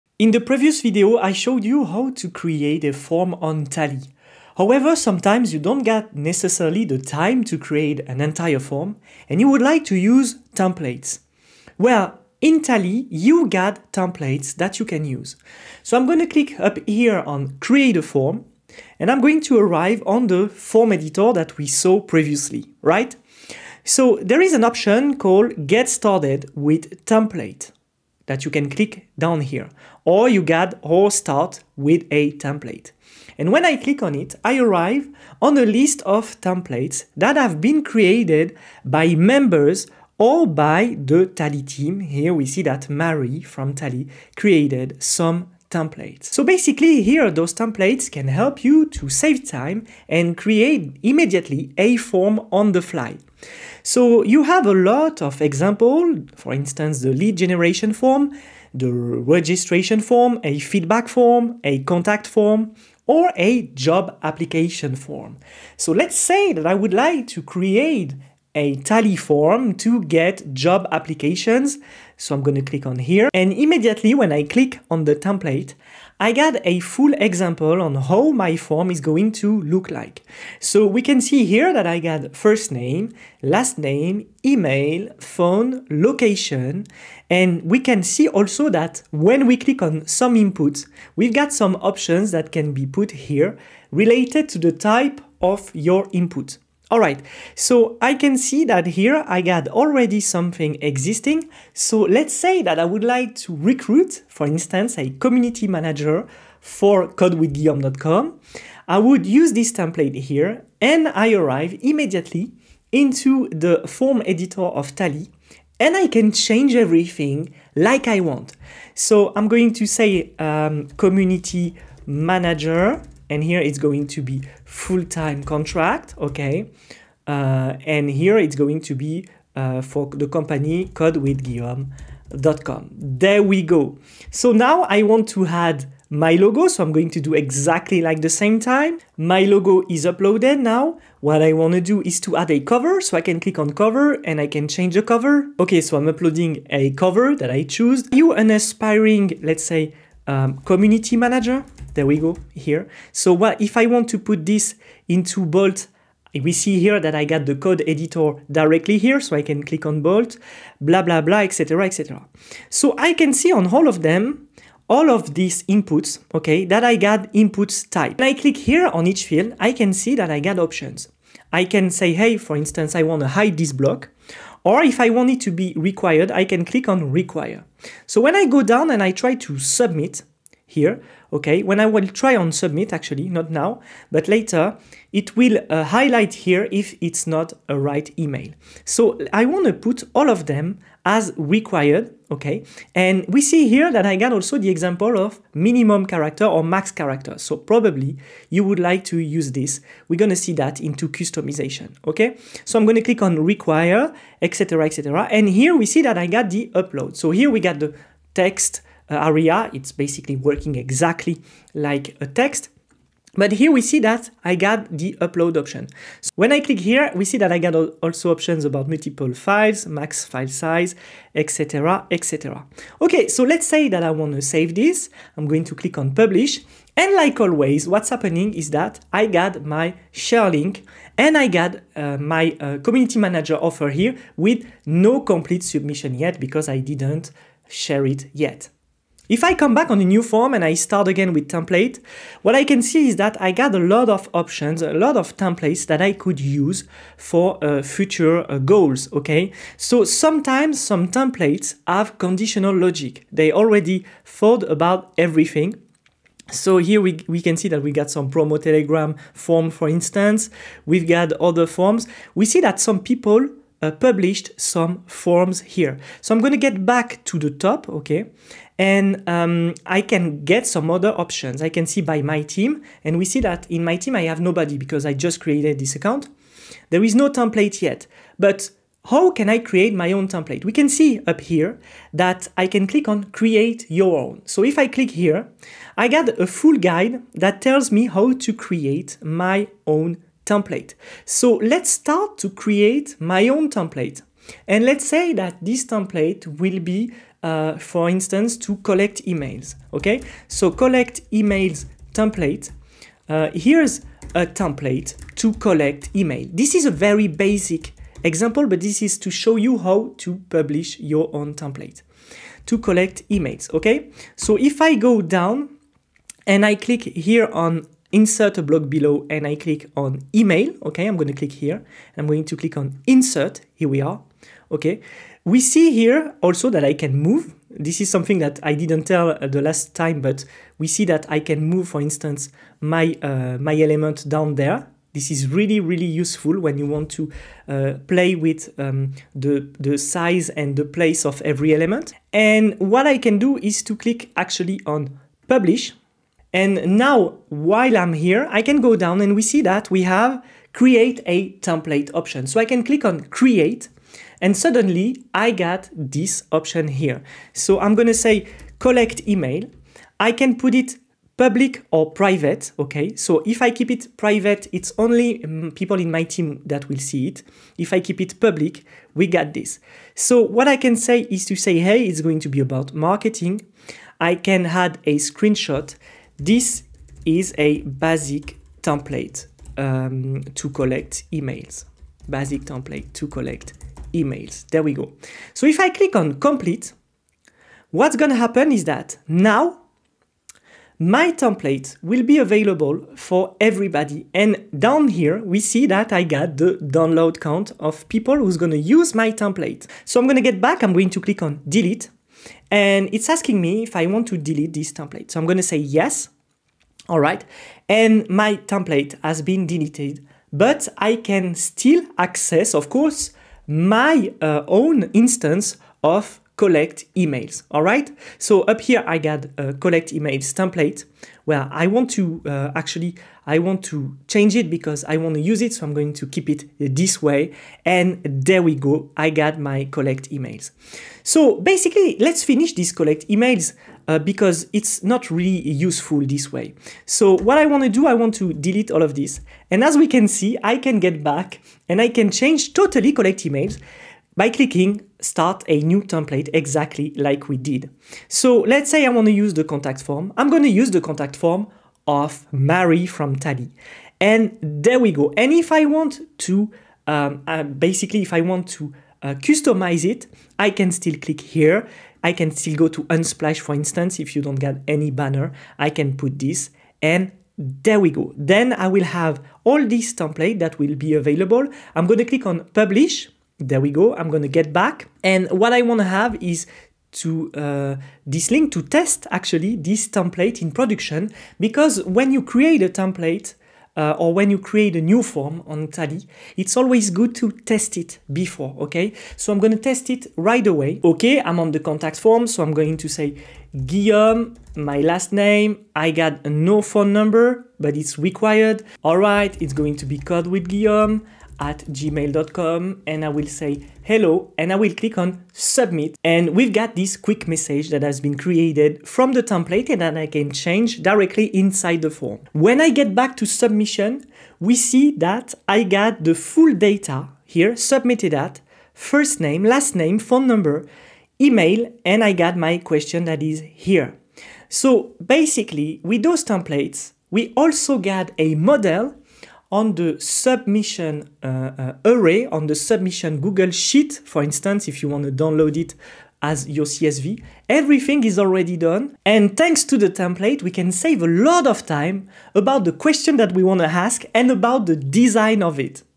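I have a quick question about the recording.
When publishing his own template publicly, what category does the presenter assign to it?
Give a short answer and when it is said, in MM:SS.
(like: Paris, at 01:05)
Marketing, at 06:12.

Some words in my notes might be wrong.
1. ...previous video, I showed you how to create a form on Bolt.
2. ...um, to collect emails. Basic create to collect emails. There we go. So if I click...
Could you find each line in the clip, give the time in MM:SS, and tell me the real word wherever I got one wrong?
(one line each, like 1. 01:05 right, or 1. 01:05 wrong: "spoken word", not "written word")
1. 00:00 wrong: "Tally", not "Bolt"
2. 06:19 wrong: "template", not "create".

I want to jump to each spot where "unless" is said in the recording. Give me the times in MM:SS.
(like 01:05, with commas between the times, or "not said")
not said.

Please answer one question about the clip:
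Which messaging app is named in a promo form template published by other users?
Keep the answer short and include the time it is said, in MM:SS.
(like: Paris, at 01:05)
Telegram, at 04:18.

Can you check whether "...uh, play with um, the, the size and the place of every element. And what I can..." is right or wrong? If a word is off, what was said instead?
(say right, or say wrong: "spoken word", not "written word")
right.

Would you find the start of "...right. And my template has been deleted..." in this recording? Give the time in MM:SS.
06:47.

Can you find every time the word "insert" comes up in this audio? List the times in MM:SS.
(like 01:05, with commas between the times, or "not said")
05:18, 05:23.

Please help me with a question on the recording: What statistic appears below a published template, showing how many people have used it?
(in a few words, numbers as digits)
Download count.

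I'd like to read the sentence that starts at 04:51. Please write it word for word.
So let's start to create my own template.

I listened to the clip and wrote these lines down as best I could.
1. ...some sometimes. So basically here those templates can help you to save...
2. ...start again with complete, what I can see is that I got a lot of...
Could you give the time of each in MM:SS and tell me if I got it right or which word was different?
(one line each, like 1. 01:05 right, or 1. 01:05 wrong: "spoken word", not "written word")
1. 00:45 wrong: "templates", not "sometimes"
2. 04:00 wrong: "template", not "complete".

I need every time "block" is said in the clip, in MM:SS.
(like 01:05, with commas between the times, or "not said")
02:53, 05:18.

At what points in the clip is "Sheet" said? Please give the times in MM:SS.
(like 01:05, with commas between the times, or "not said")
08:53.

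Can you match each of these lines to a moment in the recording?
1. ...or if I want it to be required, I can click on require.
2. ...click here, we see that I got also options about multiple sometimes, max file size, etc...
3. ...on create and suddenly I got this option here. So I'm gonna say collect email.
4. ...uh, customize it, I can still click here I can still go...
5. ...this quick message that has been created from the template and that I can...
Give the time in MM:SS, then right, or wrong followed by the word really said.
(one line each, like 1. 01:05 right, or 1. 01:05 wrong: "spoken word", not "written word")
1. 02:54 right
2. 03:36 wrong: "files", not "sometimes"
3. 05:53 right
4. 07:39 right
5. 08:26 right.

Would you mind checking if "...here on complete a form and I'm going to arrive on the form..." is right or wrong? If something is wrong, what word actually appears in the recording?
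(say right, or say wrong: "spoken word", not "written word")
wrong: "create", not "complete".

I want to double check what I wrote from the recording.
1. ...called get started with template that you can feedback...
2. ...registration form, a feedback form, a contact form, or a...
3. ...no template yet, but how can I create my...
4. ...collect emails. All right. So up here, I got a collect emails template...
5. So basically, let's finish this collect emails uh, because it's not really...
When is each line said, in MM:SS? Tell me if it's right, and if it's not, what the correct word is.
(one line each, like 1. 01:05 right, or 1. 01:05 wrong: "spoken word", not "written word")
1. 00:25 wrong: "click", not "feedback"
2. 00:58 right
3. 04:37 right
4. 06:56 right
5. 07:11 right.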